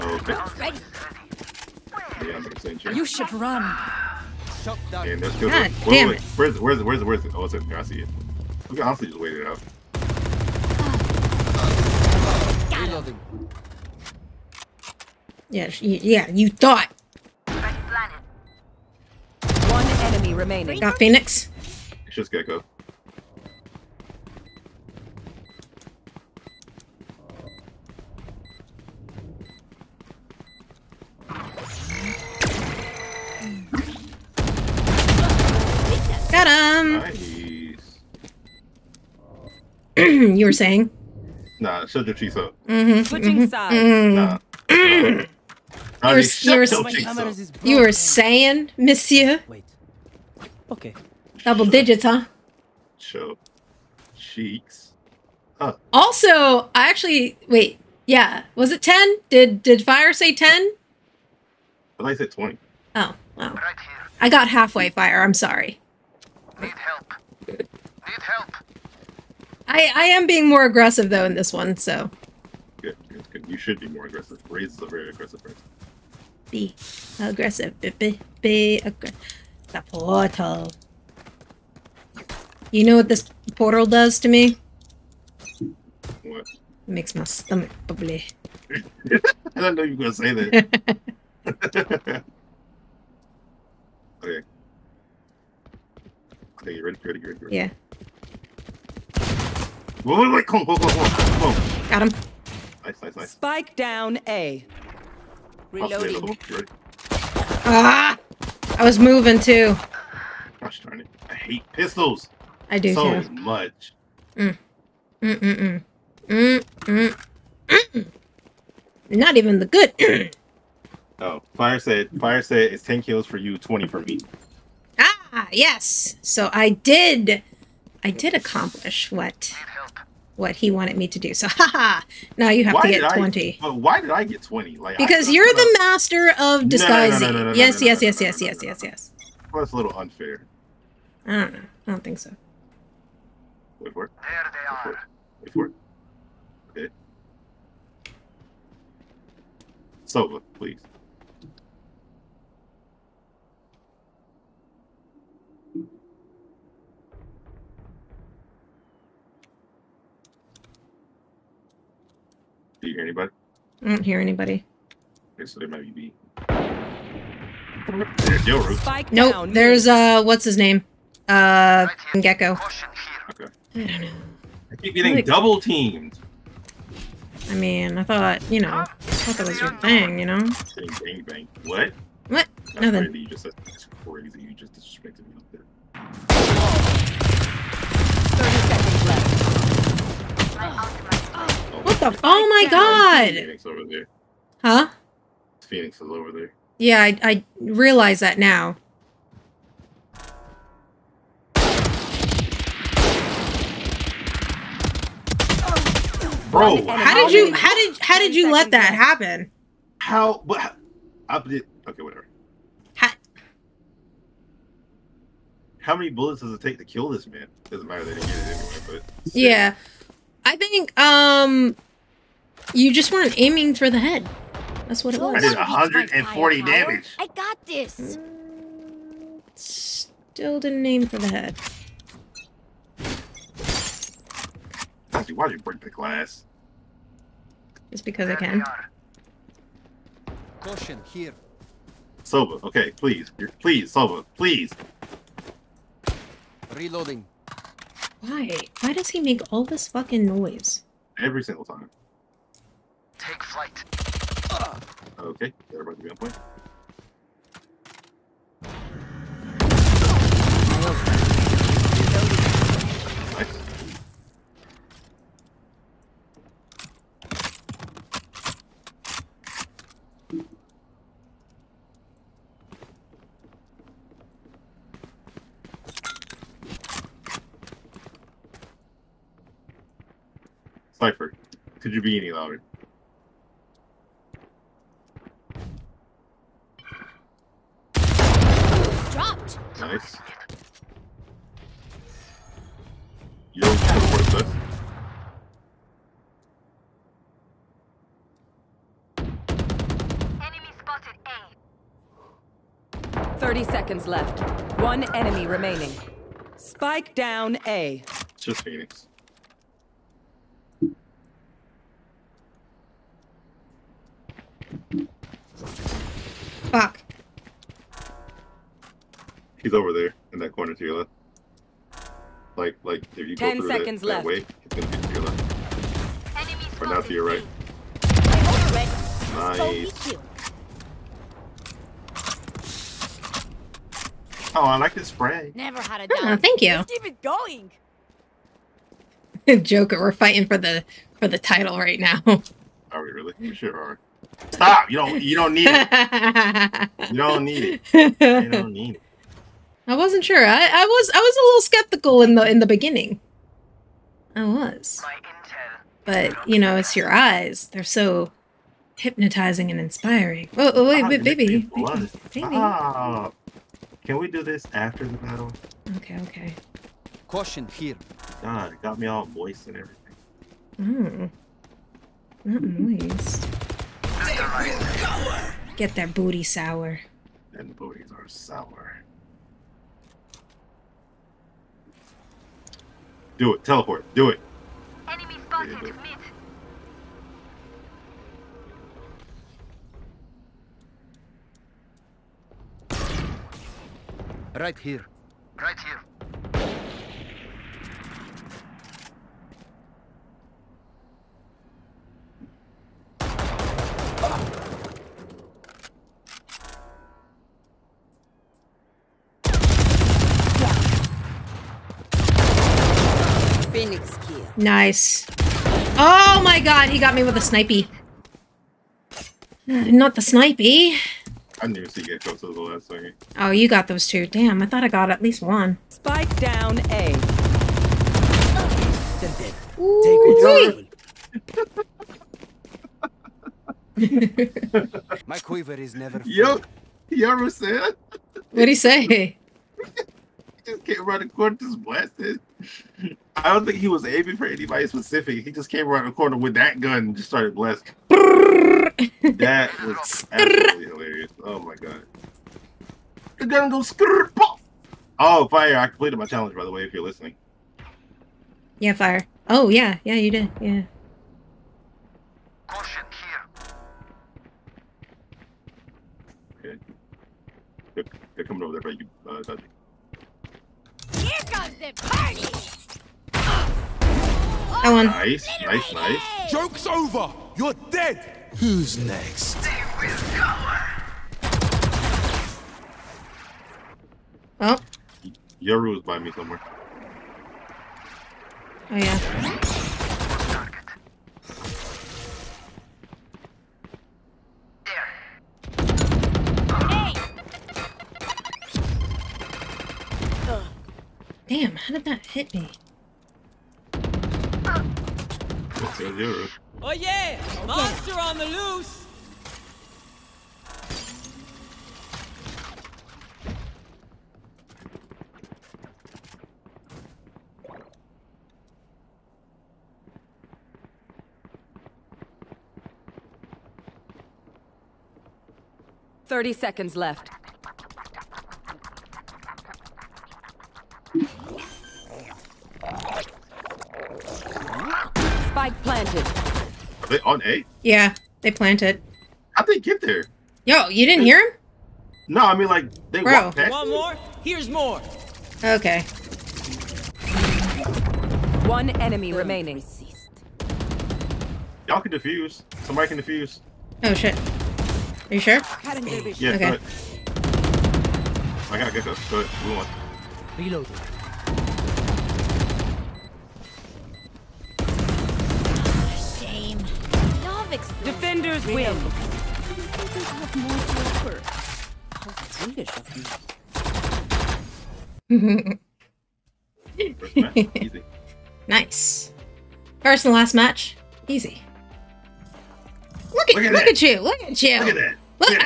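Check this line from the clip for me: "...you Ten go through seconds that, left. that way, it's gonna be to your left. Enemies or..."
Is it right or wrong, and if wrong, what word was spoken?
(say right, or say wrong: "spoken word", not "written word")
right.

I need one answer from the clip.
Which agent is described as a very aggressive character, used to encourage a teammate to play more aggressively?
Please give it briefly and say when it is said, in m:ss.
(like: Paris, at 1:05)
Raze, at 1:14.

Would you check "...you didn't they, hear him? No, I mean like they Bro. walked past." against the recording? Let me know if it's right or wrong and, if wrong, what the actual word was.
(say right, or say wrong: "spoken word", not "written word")
right.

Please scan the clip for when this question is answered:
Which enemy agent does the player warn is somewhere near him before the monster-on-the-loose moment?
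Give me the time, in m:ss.
8:05.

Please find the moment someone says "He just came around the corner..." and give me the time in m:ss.
7:25.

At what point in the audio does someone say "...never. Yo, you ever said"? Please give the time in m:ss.
7:15.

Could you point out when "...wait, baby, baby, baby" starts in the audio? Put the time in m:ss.
6:01.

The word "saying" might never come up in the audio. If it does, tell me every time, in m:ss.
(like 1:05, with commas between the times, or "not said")
0:40, 0:47.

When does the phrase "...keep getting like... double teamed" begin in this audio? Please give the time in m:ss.
2:54.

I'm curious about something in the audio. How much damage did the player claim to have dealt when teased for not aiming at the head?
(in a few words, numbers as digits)
140.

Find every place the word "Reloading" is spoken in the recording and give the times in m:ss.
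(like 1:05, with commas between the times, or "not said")
1:45, 4:06, 9:20.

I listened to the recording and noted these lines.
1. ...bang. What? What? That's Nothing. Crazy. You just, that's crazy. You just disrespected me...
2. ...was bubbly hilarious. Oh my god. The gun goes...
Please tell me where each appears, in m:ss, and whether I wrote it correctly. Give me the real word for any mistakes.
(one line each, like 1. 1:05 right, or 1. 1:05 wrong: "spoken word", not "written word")
1. 3:01 right
2. 7:29 wrong: "absolutely", not "bubbly".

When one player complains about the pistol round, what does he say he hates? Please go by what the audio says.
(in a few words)
pistols.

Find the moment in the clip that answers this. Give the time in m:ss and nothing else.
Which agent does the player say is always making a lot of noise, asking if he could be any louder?
4:40.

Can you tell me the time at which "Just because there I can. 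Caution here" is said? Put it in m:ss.
3:57.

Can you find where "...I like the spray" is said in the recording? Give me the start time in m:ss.
5:34.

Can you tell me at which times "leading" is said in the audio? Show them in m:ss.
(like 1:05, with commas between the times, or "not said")
not said.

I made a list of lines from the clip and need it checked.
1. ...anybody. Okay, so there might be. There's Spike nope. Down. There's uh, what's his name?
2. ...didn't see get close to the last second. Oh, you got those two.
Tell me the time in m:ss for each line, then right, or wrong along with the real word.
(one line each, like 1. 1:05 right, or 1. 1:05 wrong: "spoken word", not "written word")
1. 2:44 right
2. 7:01 right.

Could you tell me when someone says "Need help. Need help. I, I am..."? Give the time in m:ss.
1:06.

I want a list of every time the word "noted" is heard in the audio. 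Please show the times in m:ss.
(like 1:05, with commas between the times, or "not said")
not said.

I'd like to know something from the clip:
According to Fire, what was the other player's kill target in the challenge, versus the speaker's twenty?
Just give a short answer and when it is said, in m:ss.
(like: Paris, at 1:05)
10, at 2:02.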